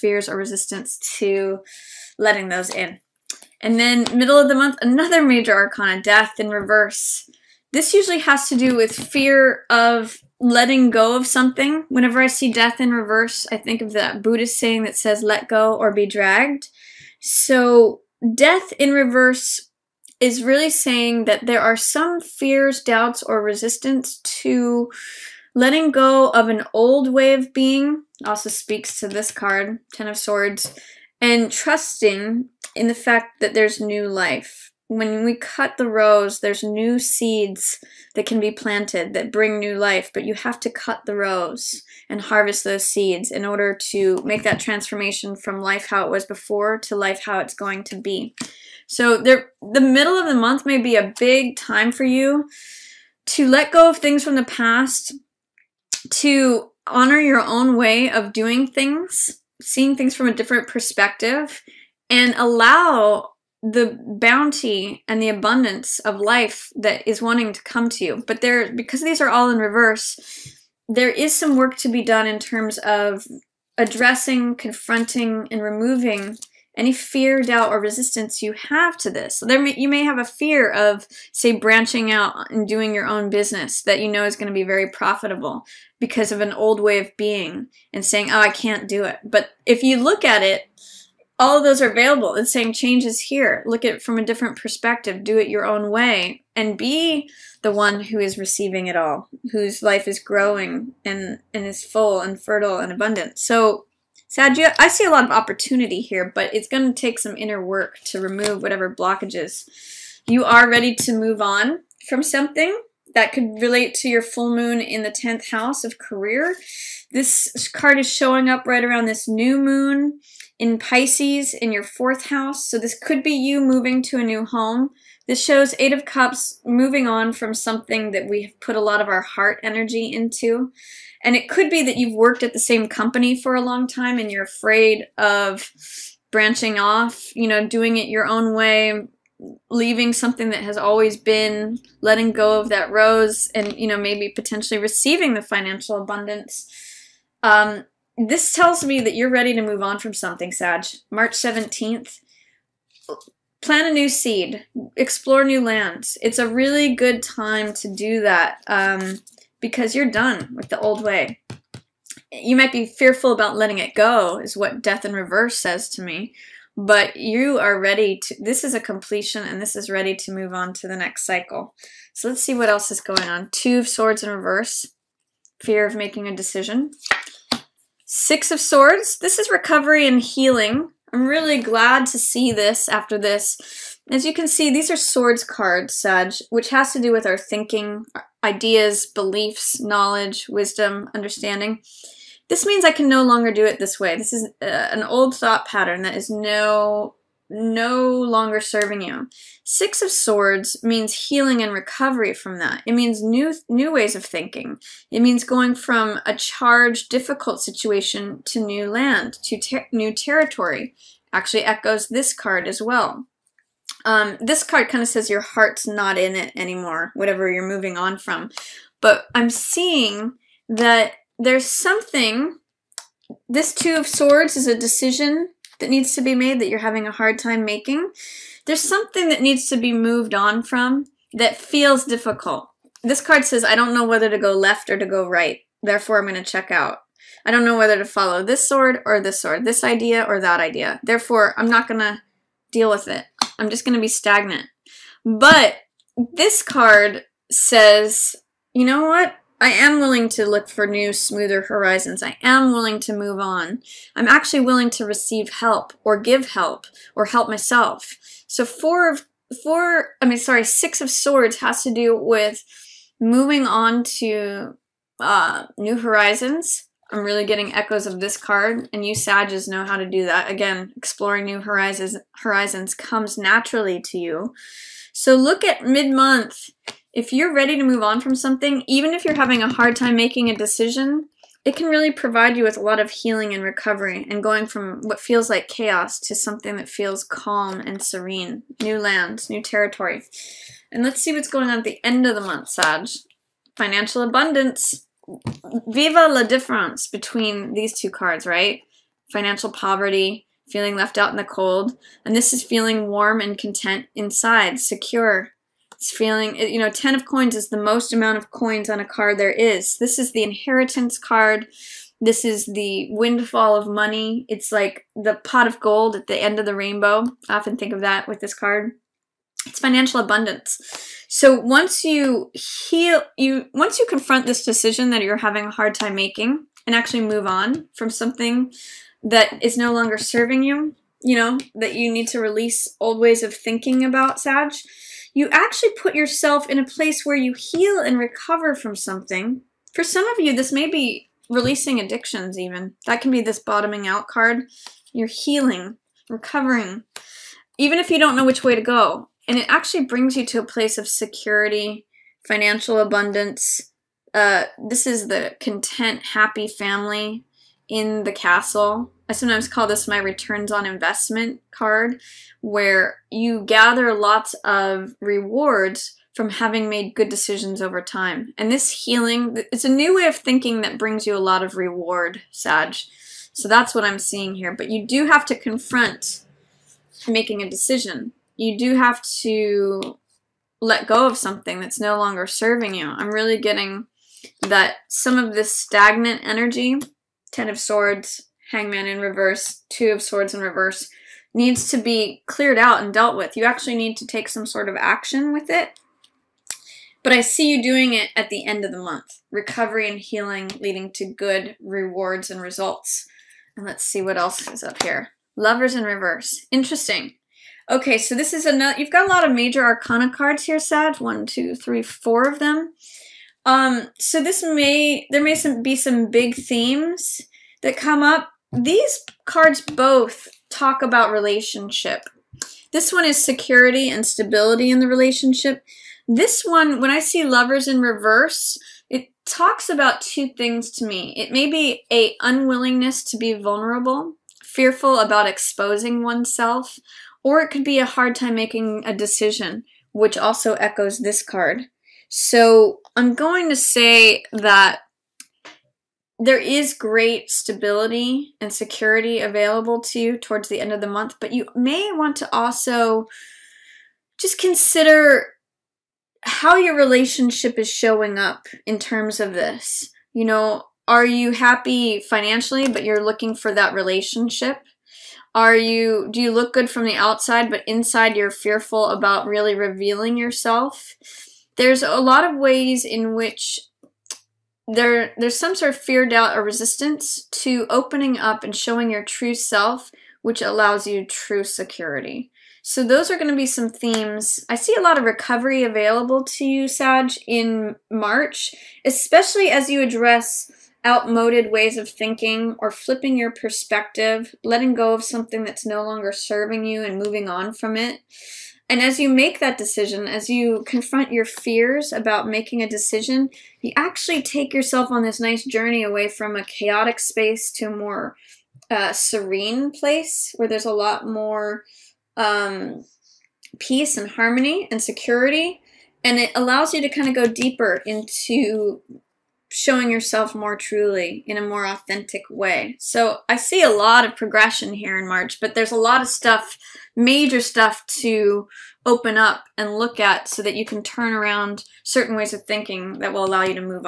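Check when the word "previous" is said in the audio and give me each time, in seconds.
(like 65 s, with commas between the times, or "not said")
not said.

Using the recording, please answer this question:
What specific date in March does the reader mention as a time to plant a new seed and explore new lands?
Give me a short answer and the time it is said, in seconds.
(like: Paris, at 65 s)
March 17, at 151 s.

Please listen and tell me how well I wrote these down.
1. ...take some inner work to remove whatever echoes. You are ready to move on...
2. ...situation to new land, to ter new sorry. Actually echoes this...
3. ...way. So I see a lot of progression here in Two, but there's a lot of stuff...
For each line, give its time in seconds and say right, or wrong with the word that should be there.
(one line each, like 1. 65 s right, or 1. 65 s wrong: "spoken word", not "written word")
1. 106 s wrong: "blockages", not "echoes"
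2. 207 s wrong: "territory", not "sorry"
3. 522 s wrong: "March", not "Two".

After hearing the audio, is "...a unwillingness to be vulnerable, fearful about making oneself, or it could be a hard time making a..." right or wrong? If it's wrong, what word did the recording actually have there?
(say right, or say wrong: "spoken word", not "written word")
wrong: "exposing", not "making".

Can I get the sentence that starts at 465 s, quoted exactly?
Are you do you look good from the outside but inside you're fearful about really revealing yourself?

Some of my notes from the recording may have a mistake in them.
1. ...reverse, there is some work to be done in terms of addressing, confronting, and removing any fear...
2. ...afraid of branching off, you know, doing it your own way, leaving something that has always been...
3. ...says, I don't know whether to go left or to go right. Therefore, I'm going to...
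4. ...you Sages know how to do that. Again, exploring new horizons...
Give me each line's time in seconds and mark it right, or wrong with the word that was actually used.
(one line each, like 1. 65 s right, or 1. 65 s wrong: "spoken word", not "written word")
1. 69 s right
2. 134 s right
3. 233 s right
4. 269 s right.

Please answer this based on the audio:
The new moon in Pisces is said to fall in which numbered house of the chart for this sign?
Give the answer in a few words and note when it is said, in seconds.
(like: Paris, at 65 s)
fourth house, at 121 s.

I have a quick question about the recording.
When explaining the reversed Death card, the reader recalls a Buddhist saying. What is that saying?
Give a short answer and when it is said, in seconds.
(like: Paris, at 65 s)
Let go or be dragged, at 15 s.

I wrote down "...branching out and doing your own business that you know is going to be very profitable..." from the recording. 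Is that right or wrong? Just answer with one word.
right.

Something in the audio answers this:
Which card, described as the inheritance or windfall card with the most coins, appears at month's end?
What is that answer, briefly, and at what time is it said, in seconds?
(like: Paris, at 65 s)
10 of coins, at 306 s.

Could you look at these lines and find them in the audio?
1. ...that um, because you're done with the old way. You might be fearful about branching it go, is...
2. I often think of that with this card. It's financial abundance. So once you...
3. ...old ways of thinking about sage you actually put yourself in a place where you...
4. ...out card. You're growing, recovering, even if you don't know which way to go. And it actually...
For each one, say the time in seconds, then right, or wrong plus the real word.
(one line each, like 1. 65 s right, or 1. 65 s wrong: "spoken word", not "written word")
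1. 158 s wrong: "letting", not "branching"
2. 317 s right
3. 332 s right
4. 344 s wrong: "healing", not "growing".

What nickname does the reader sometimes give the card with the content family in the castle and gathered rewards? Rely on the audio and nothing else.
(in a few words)
returns on investment card.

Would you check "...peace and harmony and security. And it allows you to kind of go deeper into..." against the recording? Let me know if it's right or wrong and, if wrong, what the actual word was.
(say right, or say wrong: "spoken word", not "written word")
right.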